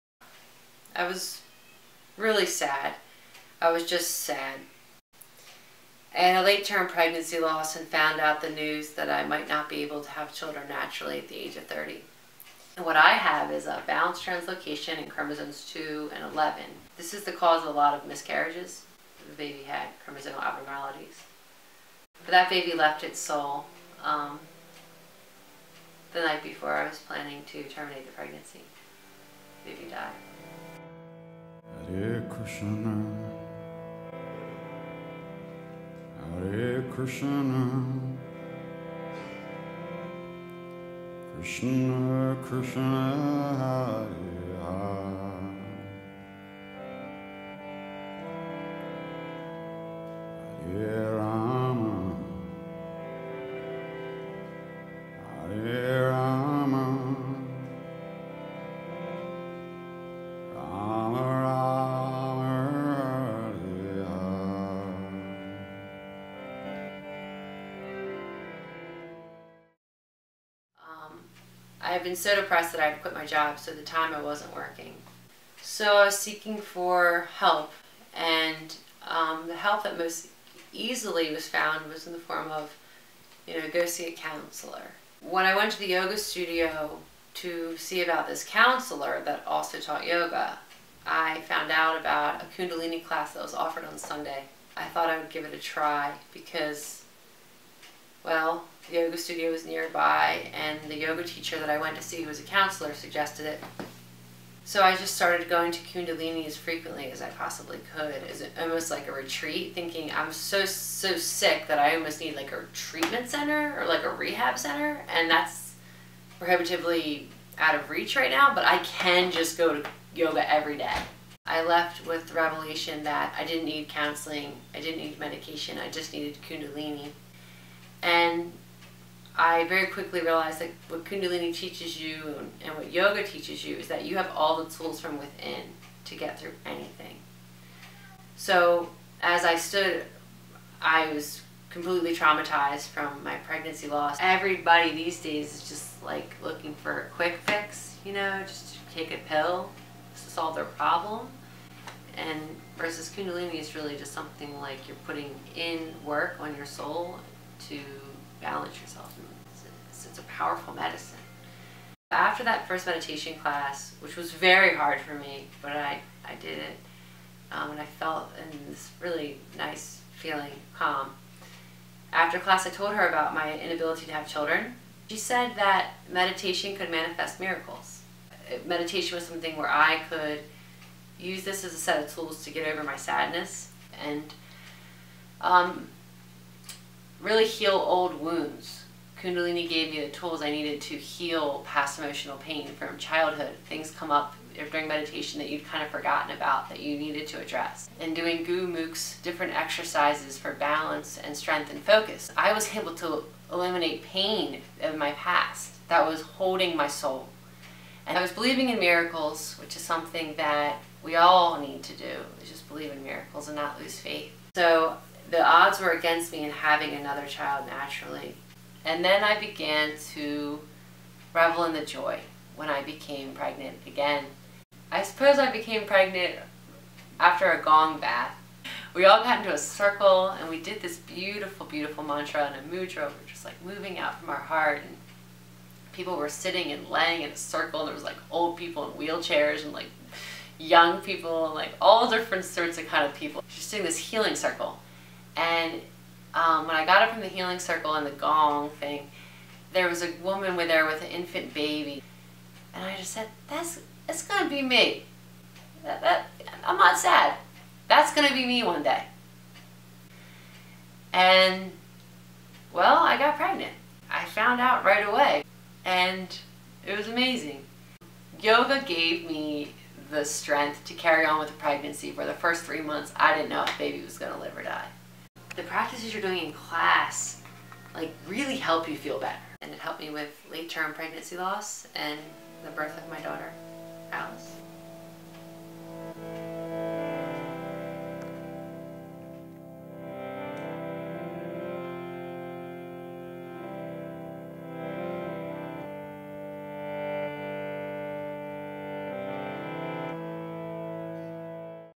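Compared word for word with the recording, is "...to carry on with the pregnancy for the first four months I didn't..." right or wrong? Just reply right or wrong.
wrong.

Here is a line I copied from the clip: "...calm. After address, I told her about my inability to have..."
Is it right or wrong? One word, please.
wrong.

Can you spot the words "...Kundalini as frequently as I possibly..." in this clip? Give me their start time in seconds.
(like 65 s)
105 s.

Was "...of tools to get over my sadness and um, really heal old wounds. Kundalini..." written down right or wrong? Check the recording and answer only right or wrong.
right.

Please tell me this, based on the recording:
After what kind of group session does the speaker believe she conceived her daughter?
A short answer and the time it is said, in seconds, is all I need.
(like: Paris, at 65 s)
A gong bath, at 227 s.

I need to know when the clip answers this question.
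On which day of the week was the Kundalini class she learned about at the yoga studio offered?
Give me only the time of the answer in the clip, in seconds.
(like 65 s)
93 s.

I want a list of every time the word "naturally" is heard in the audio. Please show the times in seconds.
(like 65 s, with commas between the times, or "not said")
10 s, 217 s.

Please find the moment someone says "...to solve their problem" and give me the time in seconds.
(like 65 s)
150 s.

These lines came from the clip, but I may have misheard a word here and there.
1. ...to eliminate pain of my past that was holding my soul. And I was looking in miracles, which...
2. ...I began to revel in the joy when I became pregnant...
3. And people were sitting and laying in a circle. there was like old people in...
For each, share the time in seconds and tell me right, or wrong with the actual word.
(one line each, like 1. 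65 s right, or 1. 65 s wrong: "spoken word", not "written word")
1. 202 s wrong: "believing", not "looking"
2. 219 s right
3. 234 s right.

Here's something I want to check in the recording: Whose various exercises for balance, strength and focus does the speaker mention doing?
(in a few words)
Gurmukh.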